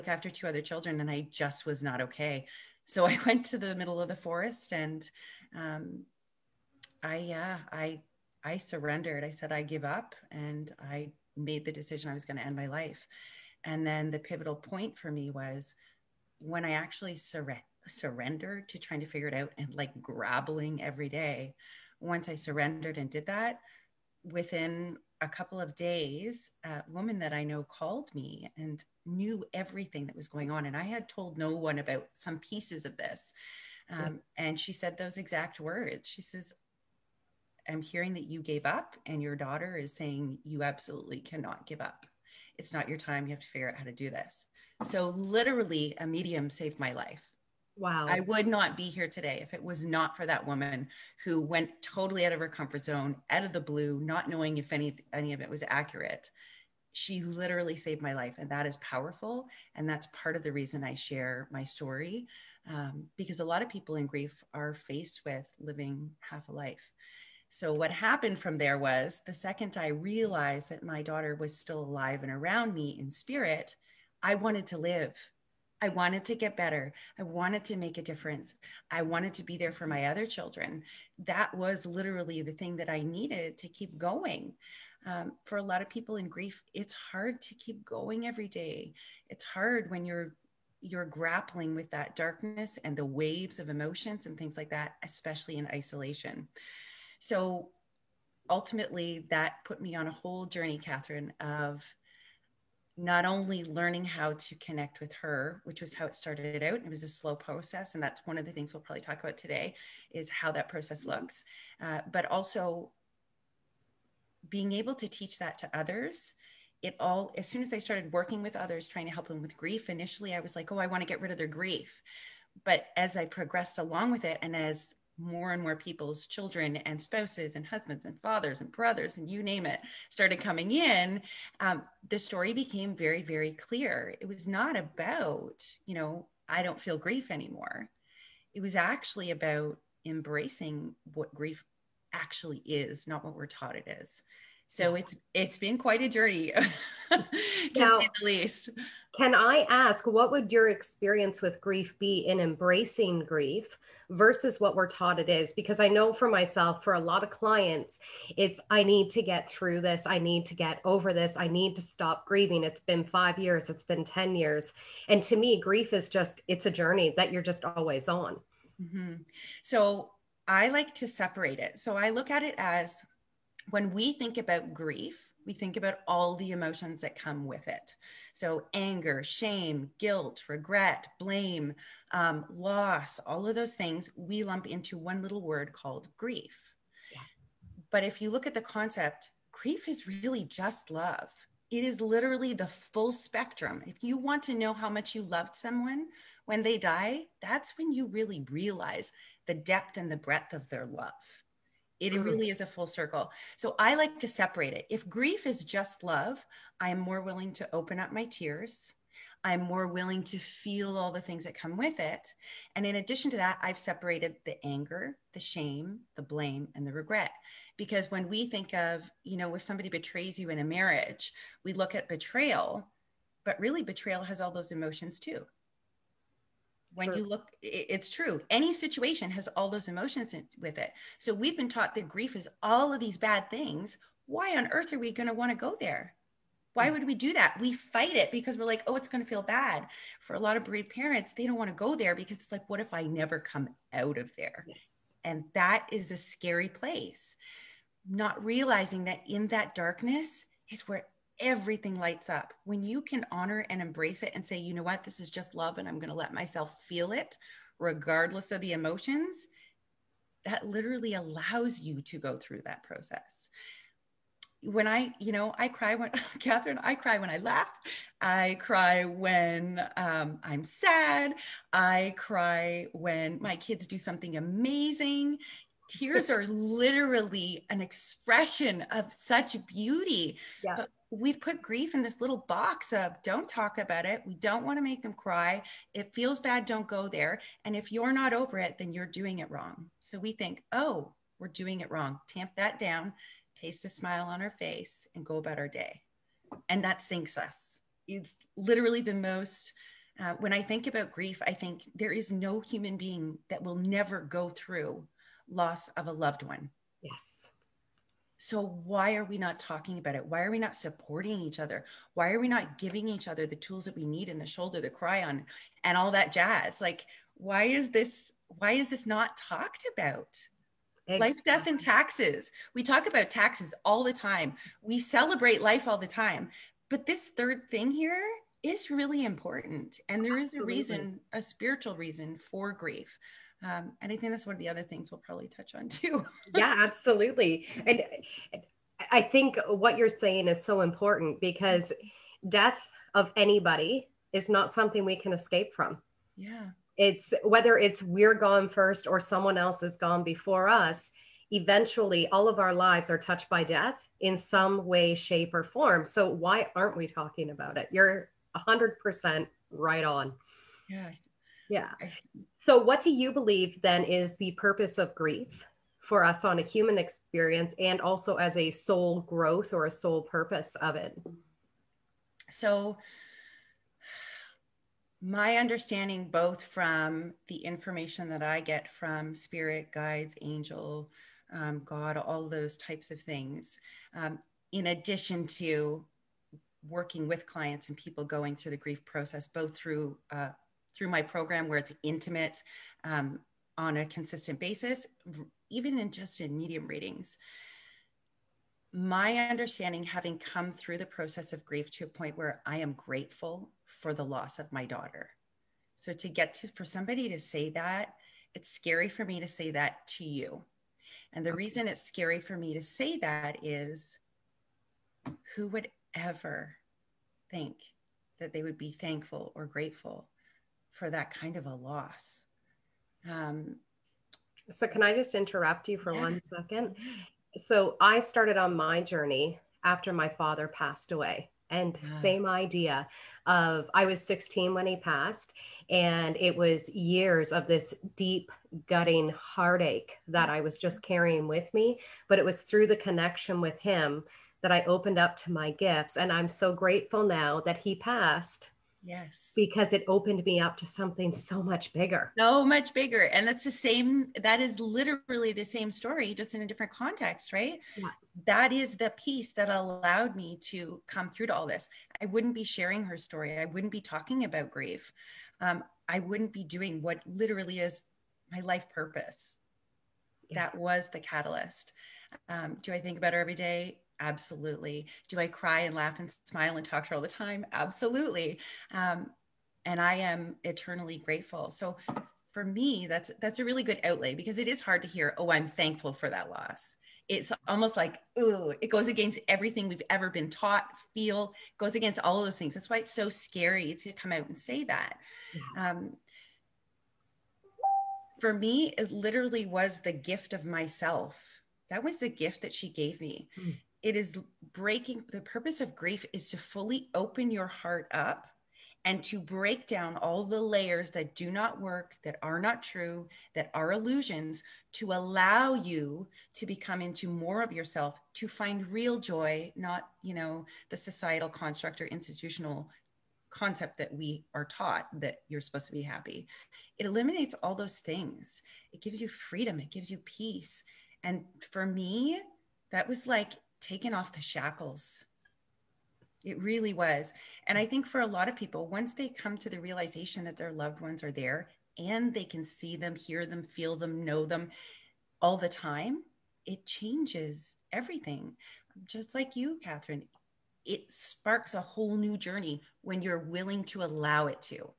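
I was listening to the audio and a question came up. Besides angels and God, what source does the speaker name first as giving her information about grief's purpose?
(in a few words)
spirit guides.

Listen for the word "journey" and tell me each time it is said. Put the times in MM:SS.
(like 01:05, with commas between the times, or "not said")
01:40, 02:26, 02:46, 07:09, 09:12.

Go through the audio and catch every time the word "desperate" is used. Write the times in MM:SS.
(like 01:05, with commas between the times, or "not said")
not said.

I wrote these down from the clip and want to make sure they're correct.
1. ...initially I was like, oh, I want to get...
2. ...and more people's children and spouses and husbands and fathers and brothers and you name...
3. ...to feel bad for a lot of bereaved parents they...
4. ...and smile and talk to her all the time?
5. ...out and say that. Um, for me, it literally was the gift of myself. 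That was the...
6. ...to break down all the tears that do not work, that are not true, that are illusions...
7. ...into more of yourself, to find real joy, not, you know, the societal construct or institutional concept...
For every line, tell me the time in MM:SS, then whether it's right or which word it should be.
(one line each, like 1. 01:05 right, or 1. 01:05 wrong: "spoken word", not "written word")
1. 01:59 right
2. 02:05 right
3. 03:59 right
4. 07:56 right
5. 08:14 right
6. 08:29 wrong: "layers", not "tears"
7. 08:37 right.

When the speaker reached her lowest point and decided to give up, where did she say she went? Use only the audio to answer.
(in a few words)
the middle of the forest.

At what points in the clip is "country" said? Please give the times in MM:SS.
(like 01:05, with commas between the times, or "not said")
not said.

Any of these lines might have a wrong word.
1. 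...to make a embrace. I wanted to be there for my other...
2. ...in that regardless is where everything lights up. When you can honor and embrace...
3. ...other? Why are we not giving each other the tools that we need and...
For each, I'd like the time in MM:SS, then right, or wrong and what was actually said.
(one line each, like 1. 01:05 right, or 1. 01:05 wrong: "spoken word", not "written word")
1. 01:17 wrong: "difference", not "embrace"
2. 04:09 wrong: "darkness", not "regardless"
3. 05:11 right.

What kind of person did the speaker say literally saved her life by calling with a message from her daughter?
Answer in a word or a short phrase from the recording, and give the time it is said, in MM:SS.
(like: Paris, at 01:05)
a medium, at 00:45.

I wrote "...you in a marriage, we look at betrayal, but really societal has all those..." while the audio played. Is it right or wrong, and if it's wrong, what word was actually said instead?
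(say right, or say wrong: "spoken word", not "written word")
wrong: "betrayal", not "societal".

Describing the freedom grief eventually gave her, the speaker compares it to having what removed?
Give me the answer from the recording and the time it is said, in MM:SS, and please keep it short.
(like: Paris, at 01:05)
the shackles, at 08:54.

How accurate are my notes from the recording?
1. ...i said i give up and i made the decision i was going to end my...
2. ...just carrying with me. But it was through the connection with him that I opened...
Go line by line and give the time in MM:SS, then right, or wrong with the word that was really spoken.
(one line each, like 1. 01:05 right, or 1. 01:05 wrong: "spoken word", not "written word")
1. 00:09 right
2. 07:20 right.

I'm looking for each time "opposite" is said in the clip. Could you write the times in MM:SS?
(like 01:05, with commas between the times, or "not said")
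not said.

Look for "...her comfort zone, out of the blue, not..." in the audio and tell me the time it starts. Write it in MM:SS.
00:52.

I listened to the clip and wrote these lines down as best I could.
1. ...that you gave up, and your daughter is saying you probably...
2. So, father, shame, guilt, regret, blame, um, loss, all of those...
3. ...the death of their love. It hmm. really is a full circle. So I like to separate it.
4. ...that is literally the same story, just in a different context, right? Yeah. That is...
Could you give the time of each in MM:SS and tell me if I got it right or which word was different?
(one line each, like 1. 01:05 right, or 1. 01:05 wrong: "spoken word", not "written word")
1. 00:38 wrong: "absolutely", not "probably"
2. 02:58 wrong: "anger", not "father"
3. 03:20 wrong: "breadth", not "death"
4. 07:34 right.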